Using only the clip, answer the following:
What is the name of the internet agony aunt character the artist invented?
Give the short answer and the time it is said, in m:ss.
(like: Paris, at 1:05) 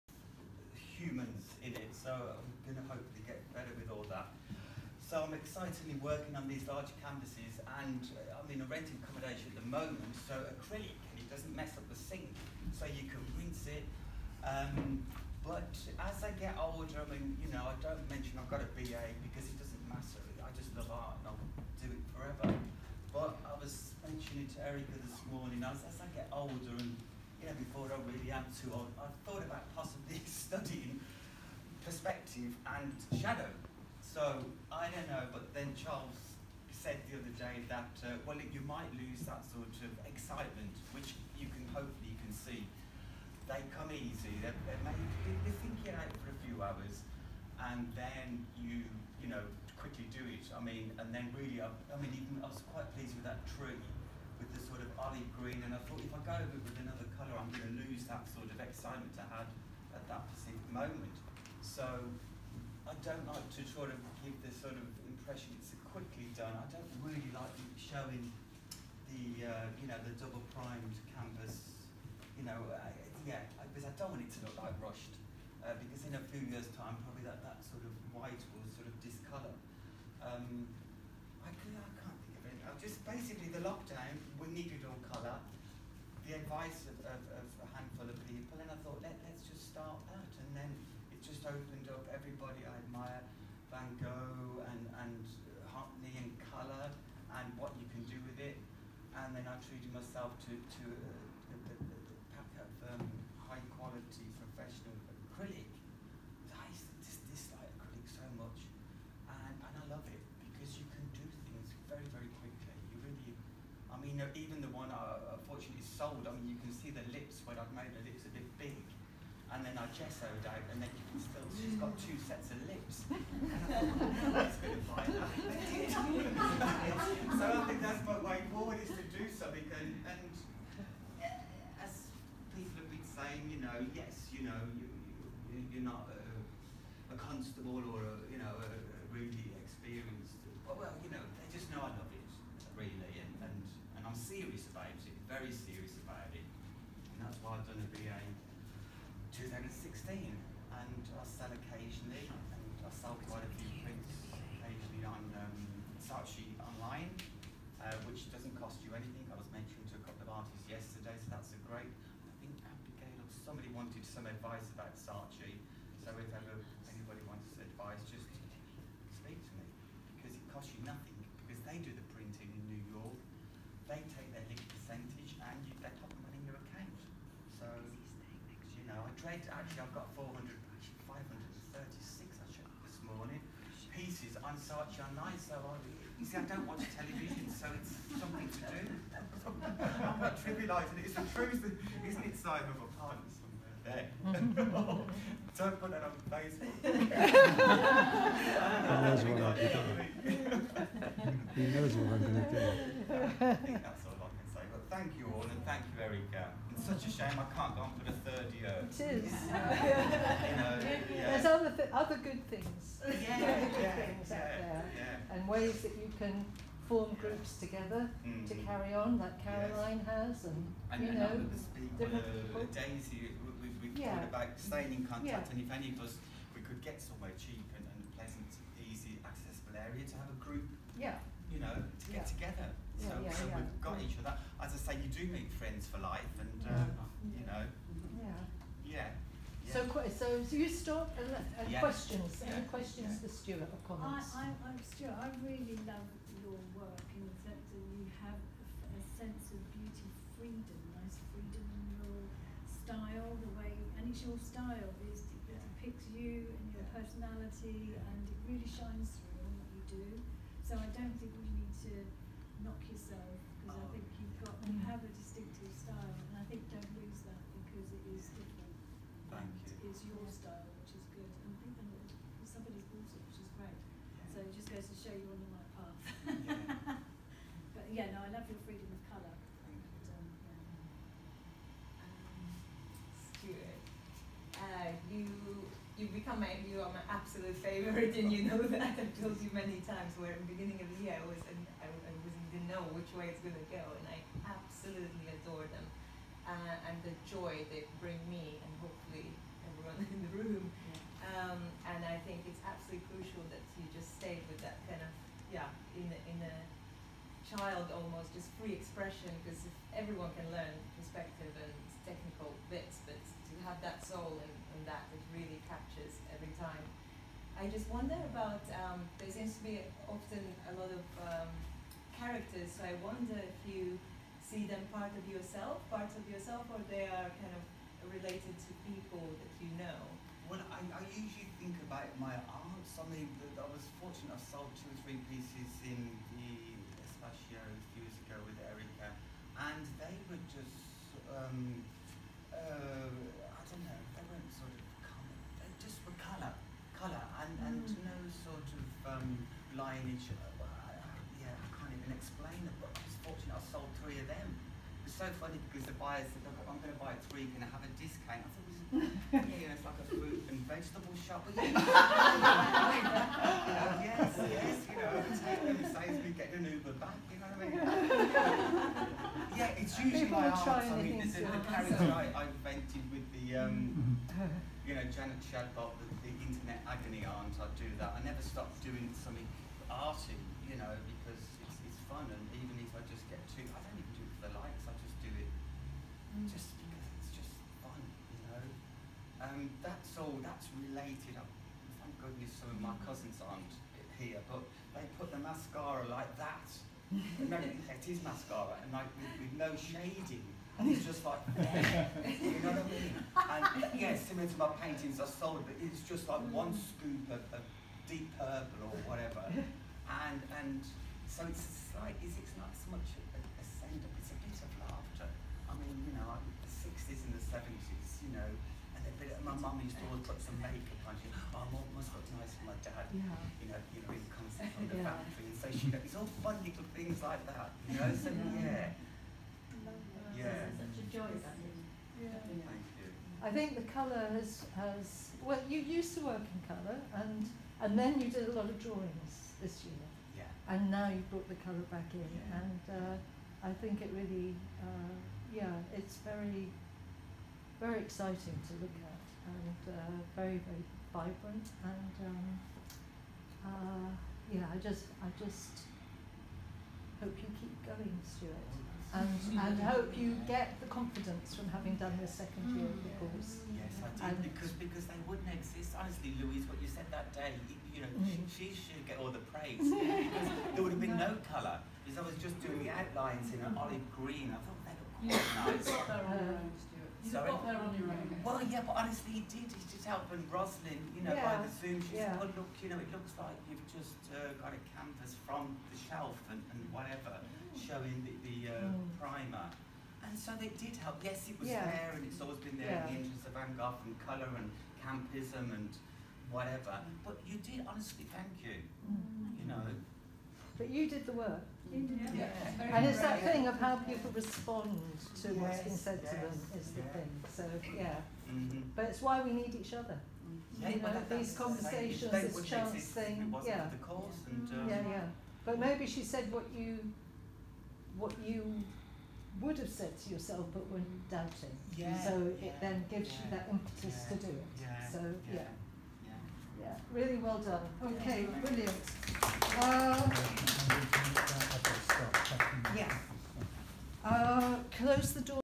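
Janet Shadbot, at 6:15.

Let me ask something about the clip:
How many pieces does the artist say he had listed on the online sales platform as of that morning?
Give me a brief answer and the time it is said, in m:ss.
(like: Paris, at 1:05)
536, at 3:01.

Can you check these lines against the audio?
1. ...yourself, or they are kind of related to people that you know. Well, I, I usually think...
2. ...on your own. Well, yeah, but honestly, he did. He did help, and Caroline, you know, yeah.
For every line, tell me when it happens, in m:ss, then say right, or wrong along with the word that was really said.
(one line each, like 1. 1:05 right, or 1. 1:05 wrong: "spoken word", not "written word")
1. 5:26 right
2. 7:57 wrong: "Roslyn", not "Caroline".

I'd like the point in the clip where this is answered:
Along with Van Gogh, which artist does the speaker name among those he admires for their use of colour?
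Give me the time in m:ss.
1:35.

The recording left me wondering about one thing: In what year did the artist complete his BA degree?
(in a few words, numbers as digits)
2016.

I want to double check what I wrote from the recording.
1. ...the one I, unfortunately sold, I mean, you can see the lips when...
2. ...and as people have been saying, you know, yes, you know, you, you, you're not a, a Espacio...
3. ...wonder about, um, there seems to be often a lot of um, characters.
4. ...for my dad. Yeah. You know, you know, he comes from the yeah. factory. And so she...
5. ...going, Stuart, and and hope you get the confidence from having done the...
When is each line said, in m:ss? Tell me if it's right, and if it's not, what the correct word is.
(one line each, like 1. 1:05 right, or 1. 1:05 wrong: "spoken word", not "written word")
1. 1:54 right
2. 2:10 wrong: "Constable", not "Espacio"
3. 5:17 right
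4. 7:02 right
5. 7:37 right.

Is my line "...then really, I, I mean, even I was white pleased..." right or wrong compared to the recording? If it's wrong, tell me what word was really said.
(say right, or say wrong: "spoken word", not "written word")
wrong: "quite", not "white".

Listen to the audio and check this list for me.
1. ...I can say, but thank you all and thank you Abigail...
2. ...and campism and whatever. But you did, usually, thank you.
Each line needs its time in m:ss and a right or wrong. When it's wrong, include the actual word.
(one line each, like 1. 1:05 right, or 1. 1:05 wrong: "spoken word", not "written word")
1. 3:24 wrong: "Erica", not "Abigail"
2. 8:14 wrong: "honestly", not "usually".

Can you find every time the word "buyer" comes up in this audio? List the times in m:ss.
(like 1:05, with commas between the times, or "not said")
5:56.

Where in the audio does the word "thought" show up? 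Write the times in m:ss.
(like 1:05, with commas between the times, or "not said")
0:29, 0:55, 1:28, 5:58, 7:54.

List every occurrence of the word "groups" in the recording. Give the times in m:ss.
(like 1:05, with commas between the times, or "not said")
3:37, 3:50.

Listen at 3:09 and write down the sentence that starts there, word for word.
I'm not trivialising it, it's the truth, isn't it Simon, a pardon somewhere there.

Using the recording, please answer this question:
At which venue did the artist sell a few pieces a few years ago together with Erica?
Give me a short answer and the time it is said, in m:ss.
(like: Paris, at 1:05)
the Espacio, at 5:36.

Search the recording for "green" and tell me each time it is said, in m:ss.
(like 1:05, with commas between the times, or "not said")
0:55, 7:54.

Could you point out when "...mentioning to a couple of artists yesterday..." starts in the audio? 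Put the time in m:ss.
2:39.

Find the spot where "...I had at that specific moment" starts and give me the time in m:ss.
0:59.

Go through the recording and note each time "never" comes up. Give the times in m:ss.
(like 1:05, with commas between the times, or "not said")
6:18.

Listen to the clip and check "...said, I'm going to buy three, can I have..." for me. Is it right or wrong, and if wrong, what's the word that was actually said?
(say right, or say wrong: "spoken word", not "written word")
right.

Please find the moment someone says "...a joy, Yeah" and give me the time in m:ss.
7:10.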